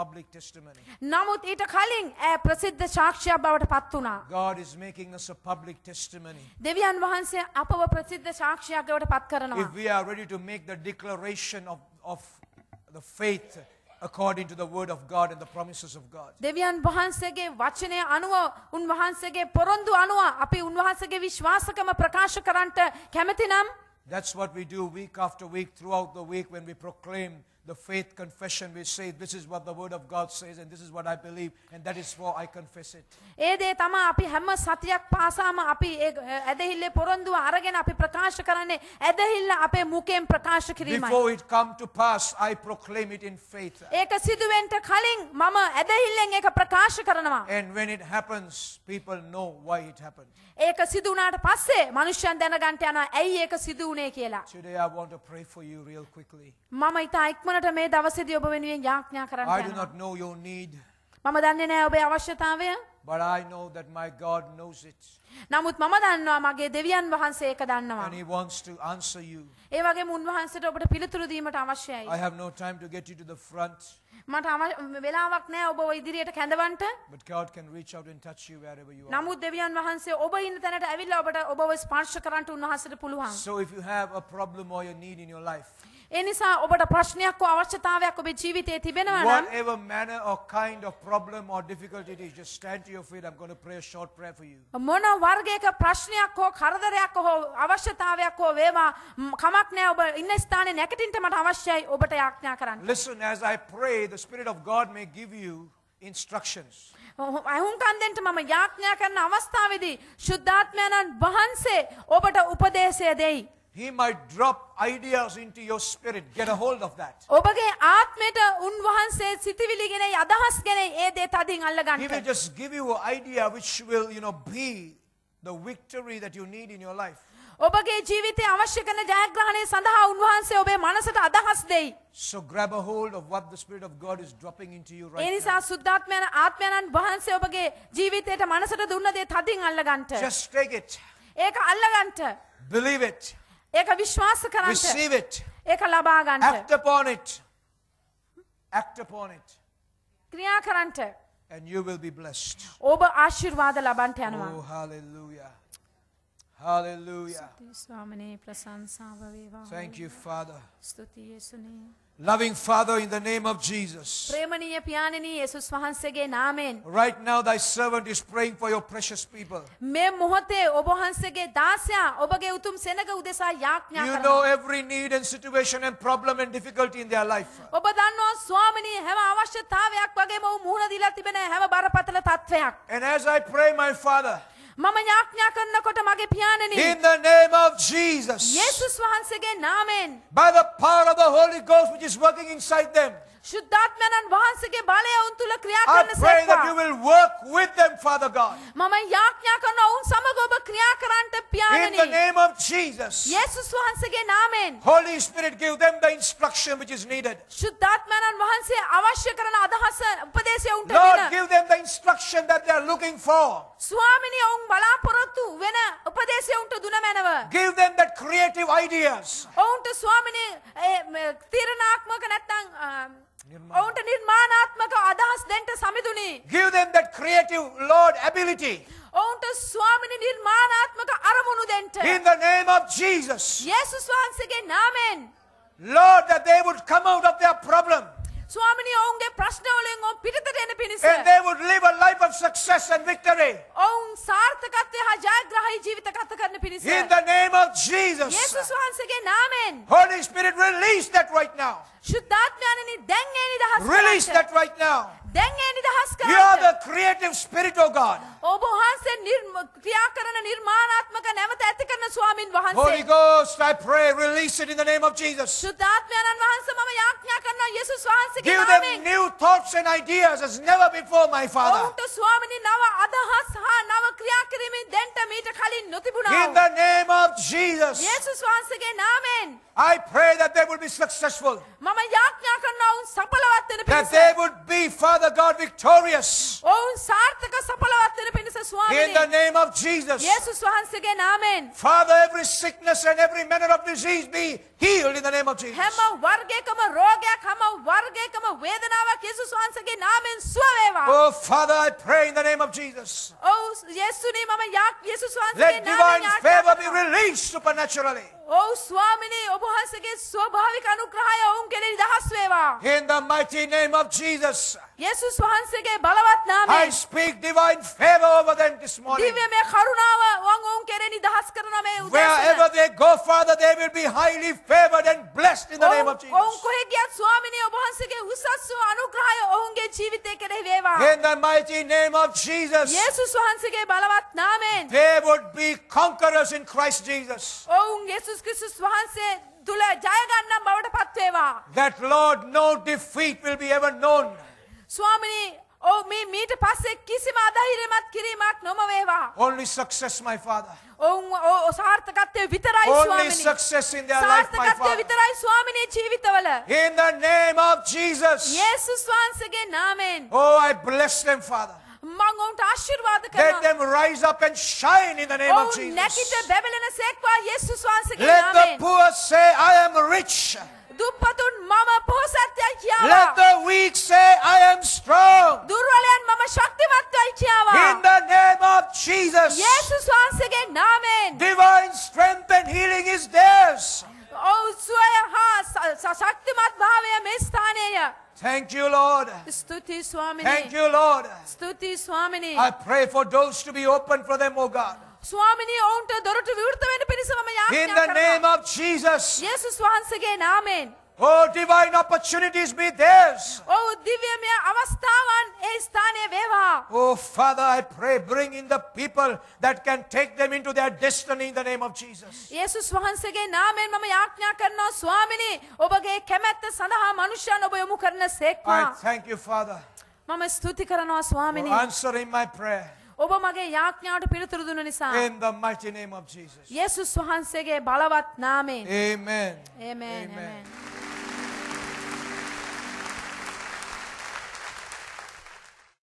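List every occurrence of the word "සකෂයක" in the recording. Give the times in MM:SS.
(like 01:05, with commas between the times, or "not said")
00:02, 00:08.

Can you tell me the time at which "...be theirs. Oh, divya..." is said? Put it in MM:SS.
06:42.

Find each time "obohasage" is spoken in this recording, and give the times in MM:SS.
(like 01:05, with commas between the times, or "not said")
05:09, 05:27.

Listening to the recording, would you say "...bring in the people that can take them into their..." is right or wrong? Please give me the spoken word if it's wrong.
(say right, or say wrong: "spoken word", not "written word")
right.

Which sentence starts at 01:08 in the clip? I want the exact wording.
And He wants to answer you.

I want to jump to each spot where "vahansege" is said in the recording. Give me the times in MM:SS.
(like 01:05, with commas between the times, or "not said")
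05:15, 05:33.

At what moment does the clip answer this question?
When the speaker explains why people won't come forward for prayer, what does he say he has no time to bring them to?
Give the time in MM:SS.
01:13.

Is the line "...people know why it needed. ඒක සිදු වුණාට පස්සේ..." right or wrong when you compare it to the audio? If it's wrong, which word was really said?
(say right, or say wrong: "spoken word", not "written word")
wrong: "happened", not "needed".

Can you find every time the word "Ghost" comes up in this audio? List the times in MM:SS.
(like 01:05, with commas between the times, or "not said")
03:11, 04:23.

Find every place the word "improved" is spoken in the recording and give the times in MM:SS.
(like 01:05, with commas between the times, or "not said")
not said.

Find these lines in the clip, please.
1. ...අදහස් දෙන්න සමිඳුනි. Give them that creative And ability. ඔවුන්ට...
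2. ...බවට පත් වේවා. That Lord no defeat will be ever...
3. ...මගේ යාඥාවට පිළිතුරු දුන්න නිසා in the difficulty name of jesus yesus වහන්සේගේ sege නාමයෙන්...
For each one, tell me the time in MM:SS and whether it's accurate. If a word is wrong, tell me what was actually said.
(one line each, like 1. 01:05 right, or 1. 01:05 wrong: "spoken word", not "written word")
1. 03:45 wrong: "Lord", not "And"
2. 05:40 right
3. 07:03 wrong: "mighty", not "difficulty".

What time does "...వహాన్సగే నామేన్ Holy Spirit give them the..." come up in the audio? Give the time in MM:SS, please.
03:23.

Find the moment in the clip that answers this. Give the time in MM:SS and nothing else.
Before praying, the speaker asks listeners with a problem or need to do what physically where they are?
01:32.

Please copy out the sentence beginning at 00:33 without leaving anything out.
ඒ දේ තමයි අපි හැම සතියක් පාසාම අපි ඒ ඇදහිල්ලේ පොරොන්දුව අරගෙන අපි ප්‍රකාශ කරන්නේ ඇදහිල්ල අපේ මුඛයෙන් ප්‍රකාශ කිරීමයි.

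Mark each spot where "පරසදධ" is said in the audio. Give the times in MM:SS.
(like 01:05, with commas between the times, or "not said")
00:02, 00:07.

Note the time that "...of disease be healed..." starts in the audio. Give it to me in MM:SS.
04:53.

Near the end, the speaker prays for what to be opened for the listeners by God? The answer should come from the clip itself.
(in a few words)
doors.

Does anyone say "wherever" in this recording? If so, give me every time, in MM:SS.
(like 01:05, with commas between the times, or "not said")
01:18, 05:22.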